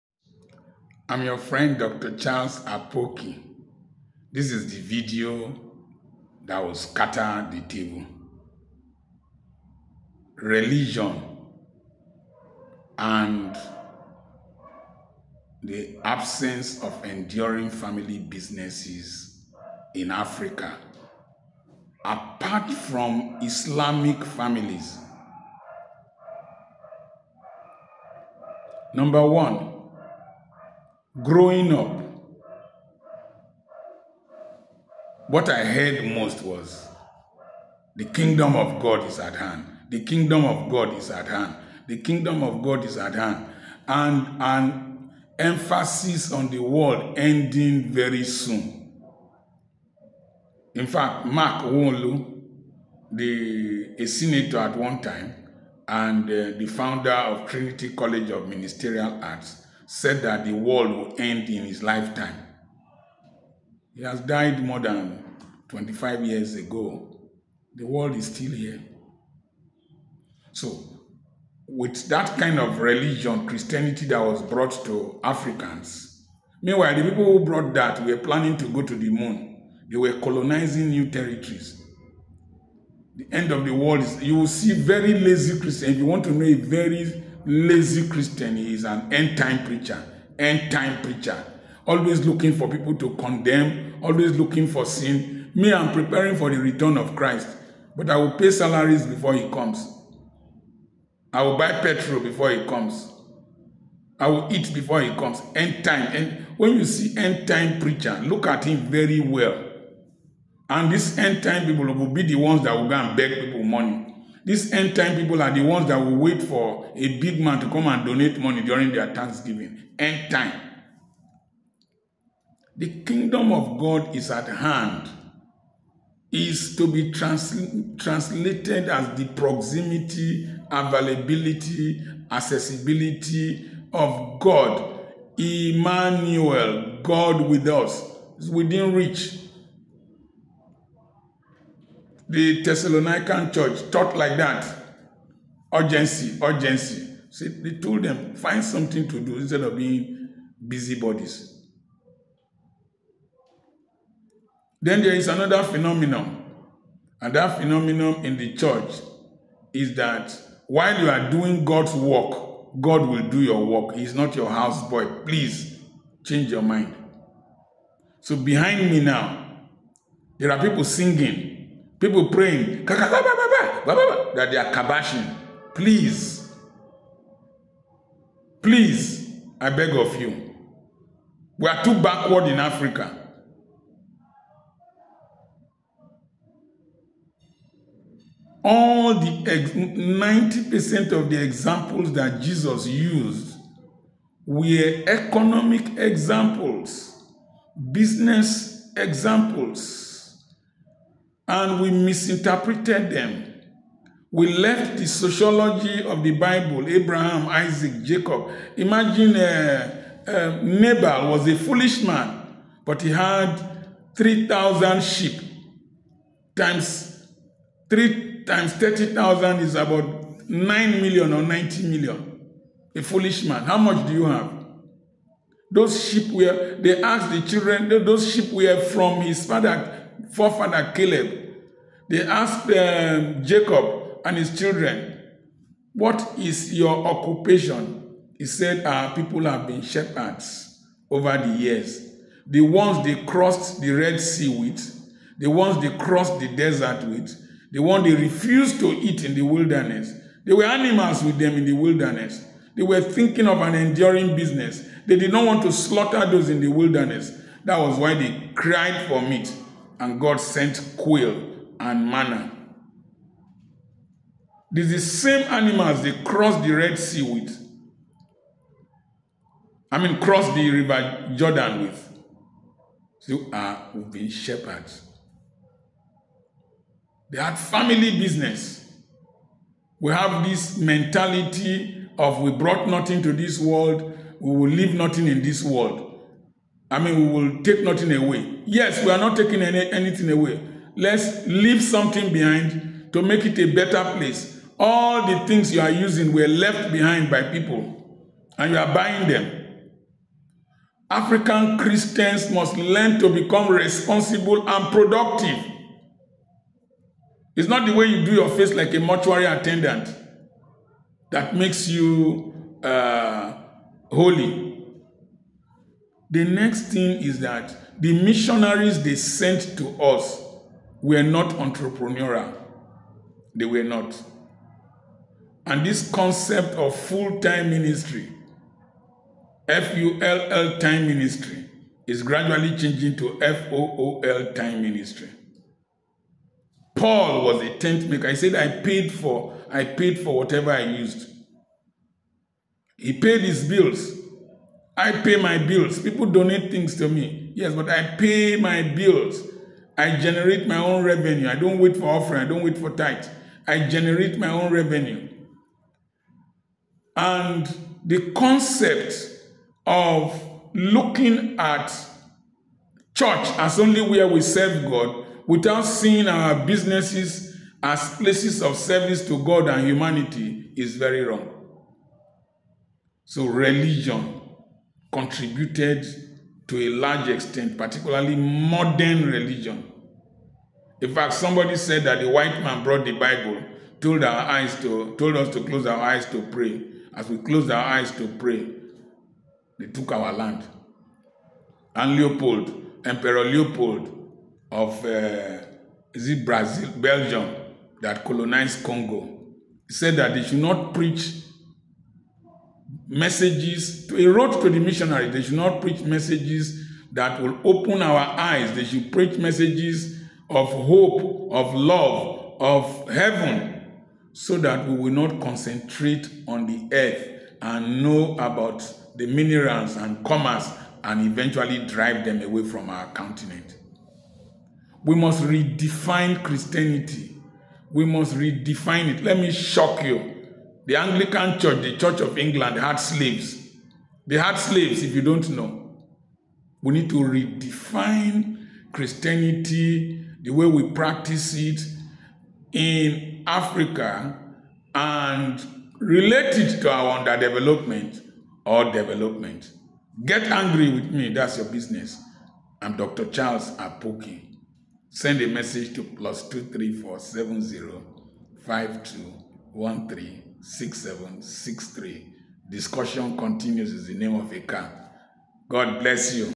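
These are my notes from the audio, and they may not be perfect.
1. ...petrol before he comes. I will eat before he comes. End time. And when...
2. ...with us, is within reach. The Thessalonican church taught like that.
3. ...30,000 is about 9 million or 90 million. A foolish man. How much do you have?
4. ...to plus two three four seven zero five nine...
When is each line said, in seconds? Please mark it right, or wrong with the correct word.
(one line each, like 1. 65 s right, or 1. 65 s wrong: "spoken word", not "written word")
1. 101 s right
2. 137 s right
3. 218 s right
4. 455 s wrong: "two", not "nine".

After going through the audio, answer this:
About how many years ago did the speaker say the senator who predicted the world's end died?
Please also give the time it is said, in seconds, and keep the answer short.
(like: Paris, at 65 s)
25, at 65 s.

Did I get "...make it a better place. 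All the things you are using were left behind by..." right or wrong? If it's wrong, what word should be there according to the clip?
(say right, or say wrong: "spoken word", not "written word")
right.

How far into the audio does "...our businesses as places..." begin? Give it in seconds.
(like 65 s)
366 s.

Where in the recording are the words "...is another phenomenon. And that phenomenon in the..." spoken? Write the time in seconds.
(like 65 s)
155 s.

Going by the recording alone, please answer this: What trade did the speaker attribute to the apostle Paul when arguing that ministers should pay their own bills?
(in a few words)
Tent maker.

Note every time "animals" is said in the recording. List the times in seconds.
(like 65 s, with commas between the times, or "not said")
250 s, 265 s.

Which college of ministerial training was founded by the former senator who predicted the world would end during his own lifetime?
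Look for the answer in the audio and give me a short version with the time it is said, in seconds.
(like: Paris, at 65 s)
Trinity College of Ministerial Arts, at 57 s.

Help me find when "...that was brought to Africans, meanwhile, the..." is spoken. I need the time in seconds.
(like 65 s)
74 s.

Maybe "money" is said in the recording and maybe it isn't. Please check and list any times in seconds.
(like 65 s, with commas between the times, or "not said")
113 s, 118 s.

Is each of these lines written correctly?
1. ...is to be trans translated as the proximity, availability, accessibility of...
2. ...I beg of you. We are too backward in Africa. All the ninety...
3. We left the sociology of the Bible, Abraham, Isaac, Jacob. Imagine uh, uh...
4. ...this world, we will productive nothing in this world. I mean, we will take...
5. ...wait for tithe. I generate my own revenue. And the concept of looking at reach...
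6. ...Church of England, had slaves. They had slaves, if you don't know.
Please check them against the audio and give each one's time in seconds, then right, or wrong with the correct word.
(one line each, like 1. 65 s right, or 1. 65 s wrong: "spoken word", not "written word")
1. 126 s right
2. 179 s right
3. 204 s right
4. 283 s wrong: "leave", not "productive"
5. 352 s wrong: "church", not "reach"
6. 431 s right.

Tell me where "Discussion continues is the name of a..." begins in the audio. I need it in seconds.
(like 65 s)
462 s.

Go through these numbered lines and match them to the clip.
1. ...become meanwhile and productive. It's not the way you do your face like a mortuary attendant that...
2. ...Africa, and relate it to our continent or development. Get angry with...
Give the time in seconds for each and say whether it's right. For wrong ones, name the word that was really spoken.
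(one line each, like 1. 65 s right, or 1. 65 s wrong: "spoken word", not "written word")
1. 303 s wrong: "responsible", not "meanwhile"
2. 443 s wrong: "underdevelopment", not "continent".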